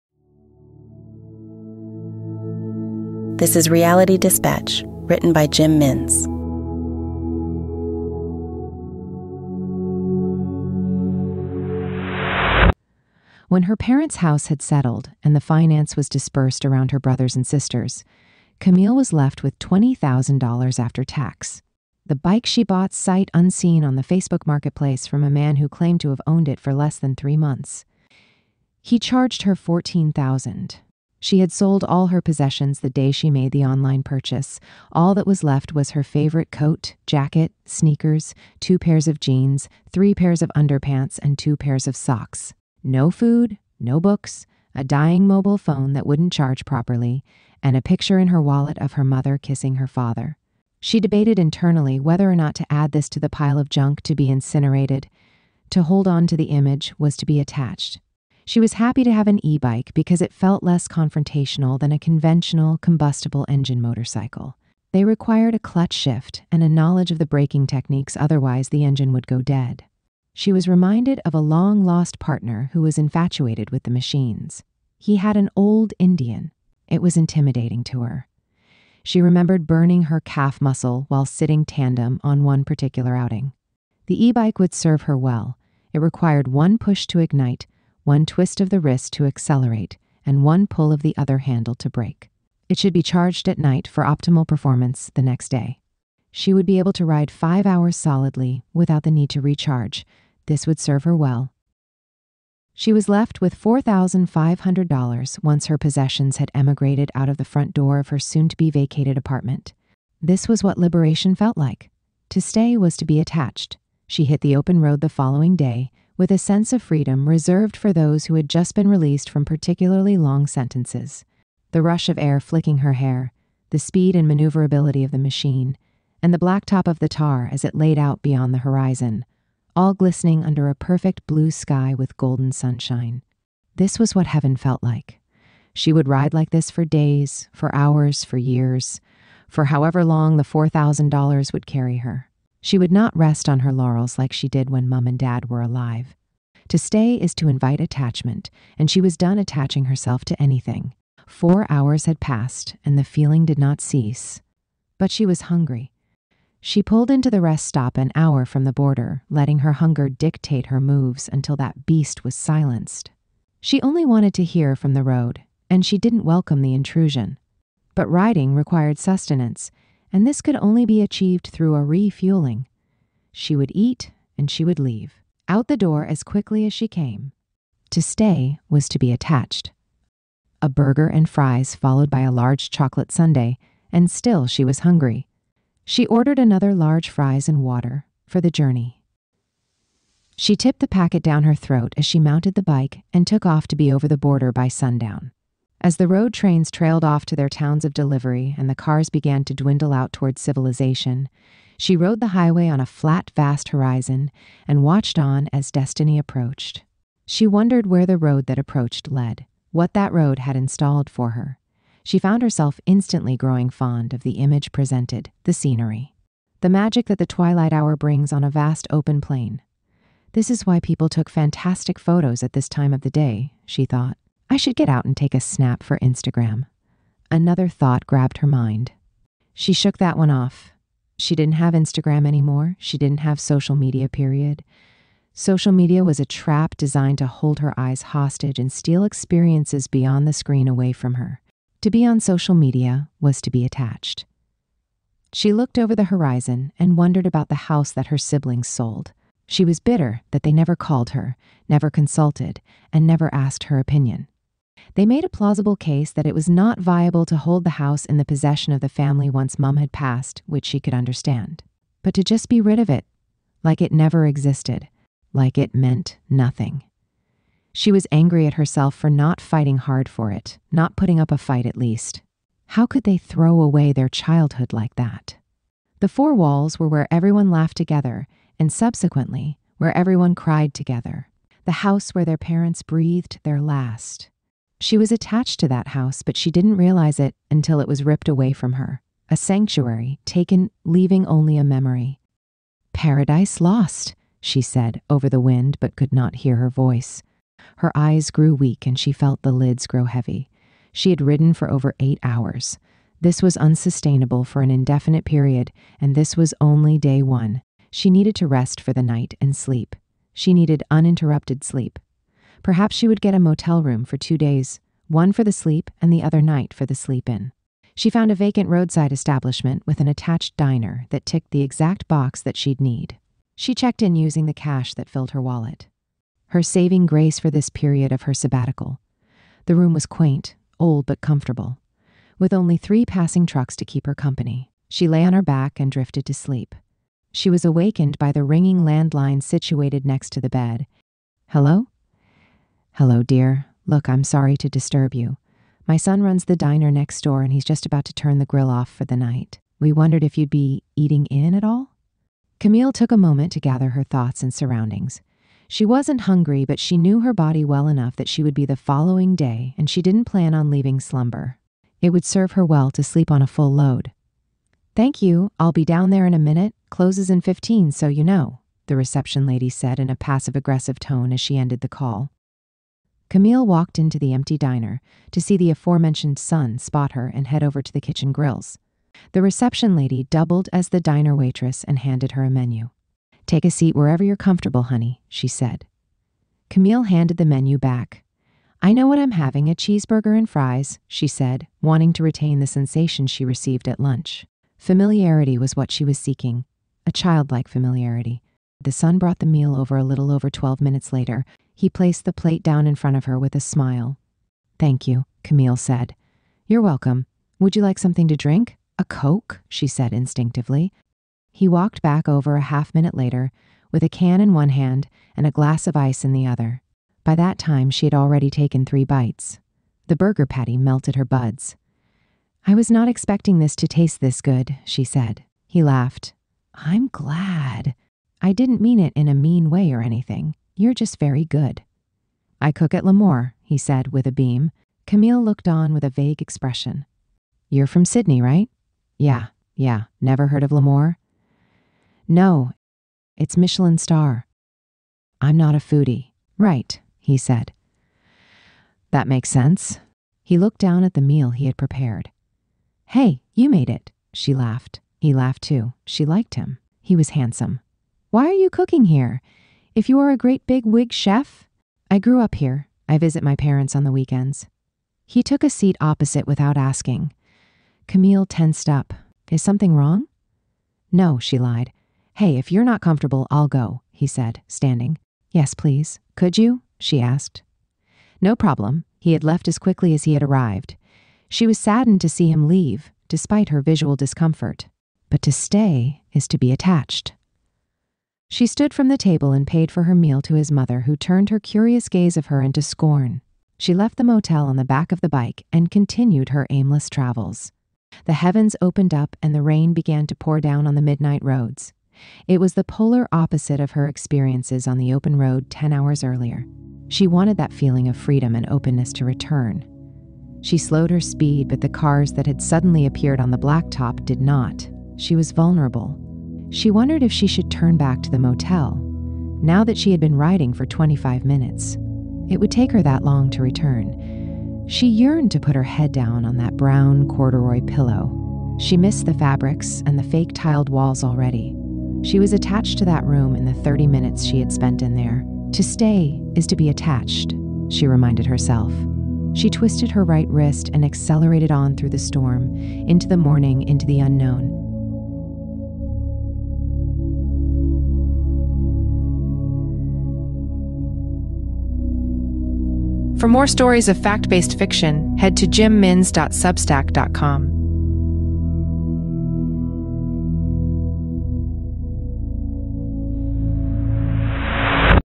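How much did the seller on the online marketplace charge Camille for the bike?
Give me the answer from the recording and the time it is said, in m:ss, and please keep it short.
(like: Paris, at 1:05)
14,000, at 0:29.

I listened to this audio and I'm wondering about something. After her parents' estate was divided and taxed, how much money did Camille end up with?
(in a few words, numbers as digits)
$20,000.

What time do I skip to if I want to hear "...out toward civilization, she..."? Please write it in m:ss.
3:19.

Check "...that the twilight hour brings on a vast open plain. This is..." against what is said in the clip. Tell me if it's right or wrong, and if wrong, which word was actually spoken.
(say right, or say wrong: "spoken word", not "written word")
right.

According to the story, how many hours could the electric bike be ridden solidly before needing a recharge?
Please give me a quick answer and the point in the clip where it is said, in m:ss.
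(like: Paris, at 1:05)
5, at 1:37.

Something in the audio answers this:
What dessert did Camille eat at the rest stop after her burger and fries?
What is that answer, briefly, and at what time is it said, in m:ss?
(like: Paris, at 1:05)
Chocolate sundae, at 3:02.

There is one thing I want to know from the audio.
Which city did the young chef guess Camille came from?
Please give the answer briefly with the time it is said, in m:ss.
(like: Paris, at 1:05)
Sydney, at 7:18.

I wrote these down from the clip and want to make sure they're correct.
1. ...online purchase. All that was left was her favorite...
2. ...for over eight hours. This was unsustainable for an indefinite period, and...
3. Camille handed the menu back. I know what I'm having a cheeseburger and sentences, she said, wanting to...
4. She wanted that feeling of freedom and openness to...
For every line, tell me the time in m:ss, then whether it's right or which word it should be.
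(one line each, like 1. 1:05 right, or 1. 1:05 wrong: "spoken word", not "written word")
1. 0:33 right
2. 5:01 right
3. 6:26 wrong: "fries", not "sentences"
4. 8:27 right.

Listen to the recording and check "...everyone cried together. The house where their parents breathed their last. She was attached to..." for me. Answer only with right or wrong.
right.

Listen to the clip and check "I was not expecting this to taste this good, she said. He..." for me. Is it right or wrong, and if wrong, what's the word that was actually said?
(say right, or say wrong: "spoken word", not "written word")
right.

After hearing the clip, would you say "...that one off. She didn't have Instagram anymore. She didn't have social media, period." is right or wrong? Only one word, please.
right.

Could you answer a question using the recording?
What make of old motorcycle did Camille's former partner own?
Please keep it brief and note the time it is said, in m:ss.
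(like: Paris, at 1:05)
Indian, at 1:15.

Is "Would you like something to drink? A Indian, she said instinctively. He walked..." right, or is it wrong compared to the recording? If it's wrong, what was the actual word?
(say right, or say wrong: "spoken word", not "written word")
wrong: "Coke", not "Indian".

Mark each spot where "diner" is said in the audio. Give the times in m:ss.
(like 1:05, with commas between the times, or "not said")
5:20, 5:46, 6:14, 6:20.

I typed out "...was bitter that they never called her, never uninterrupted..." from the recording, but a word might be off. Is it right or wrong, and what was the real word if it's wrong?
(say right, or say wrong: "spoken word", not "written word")
wrong: "consulted", not "uninterrupted".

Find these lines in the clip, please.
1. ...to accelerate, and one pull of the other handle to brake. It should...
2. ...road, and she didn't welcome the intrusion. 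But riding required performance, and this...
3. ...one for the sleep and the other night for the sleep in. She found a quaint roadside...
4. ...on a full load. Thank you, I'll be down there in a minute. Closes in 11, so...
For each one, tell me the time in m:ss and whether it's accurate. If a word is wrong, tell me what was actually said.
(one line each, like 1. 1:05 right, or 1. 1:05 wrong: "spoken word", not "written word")
1. 1:29 right
2. 2:45 wrong: "sustenance", not "performance"
3. 5:15 wrong: "vacant", not "quaint"
4. 6:03 wrong: "15", not "11".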